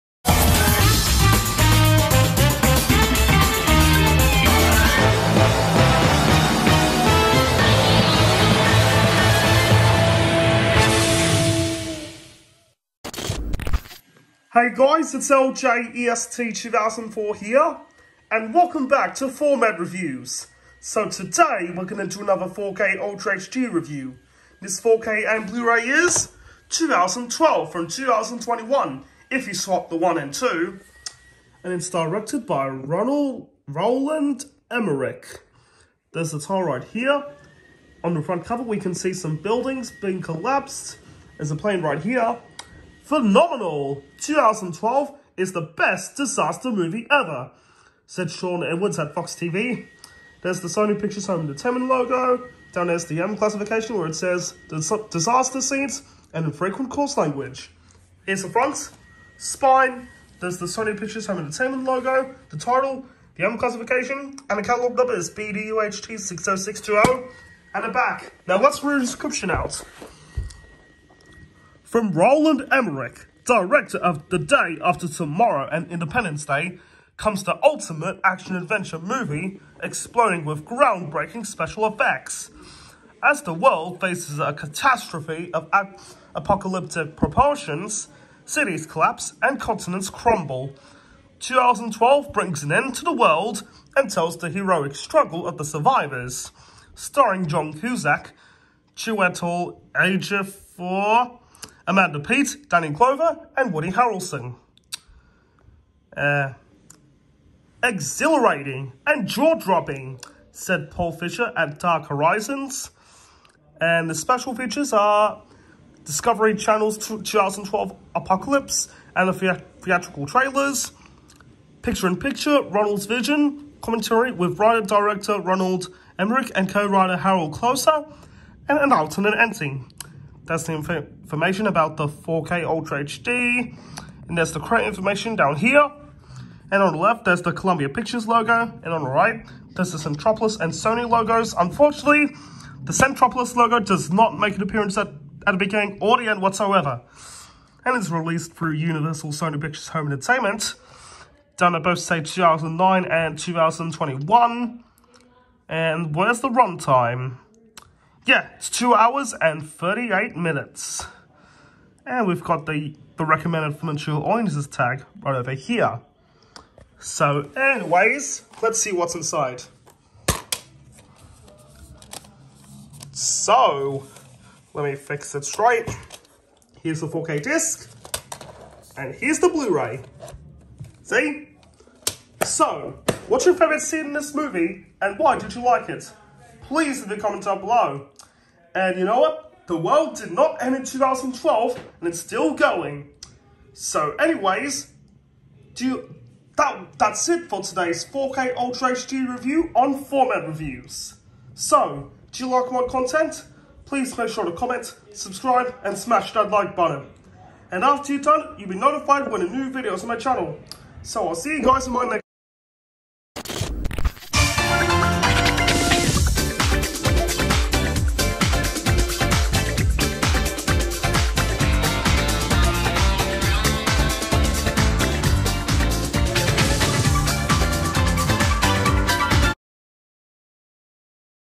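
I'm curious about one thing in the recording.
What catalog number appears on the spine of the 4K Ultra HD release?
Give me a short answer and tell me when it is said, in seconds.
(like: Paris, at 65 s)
BDUHT60620, at 65 s.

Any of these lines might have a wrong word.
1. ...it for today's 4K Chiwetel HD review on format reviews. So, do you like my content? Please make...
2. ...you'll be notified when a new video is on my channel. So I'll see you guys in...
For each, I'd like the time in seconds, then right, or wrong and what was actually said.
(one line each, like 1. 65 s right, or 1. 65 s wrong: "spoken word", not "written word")
1. 197 s wrong: "Ultra", not "Chiwetel"
2. 208 s right.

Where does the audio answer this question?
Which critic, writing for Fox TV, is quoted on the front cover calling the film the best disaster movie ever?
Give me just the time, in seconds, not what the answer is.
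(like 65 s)
48 s.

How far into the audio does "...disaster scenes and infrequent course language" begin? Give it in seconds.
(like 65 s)
54 s.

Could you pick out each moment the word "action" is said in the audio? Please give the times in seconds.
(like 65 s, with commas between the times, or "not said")
78 s.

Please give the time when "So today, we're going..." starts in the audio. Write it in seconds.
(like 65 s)
20 s.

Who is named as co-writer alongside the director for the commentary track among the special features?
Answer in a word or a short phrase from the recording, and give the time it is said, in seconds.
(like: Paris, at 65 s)
Harald Kloser, at 127 s.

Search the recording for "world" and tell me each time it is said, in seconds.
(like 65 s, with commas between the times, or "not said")
83 s, 93 s, 189 s.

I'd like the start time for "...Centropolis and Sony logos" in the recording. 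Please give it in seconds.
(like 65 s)
139 s.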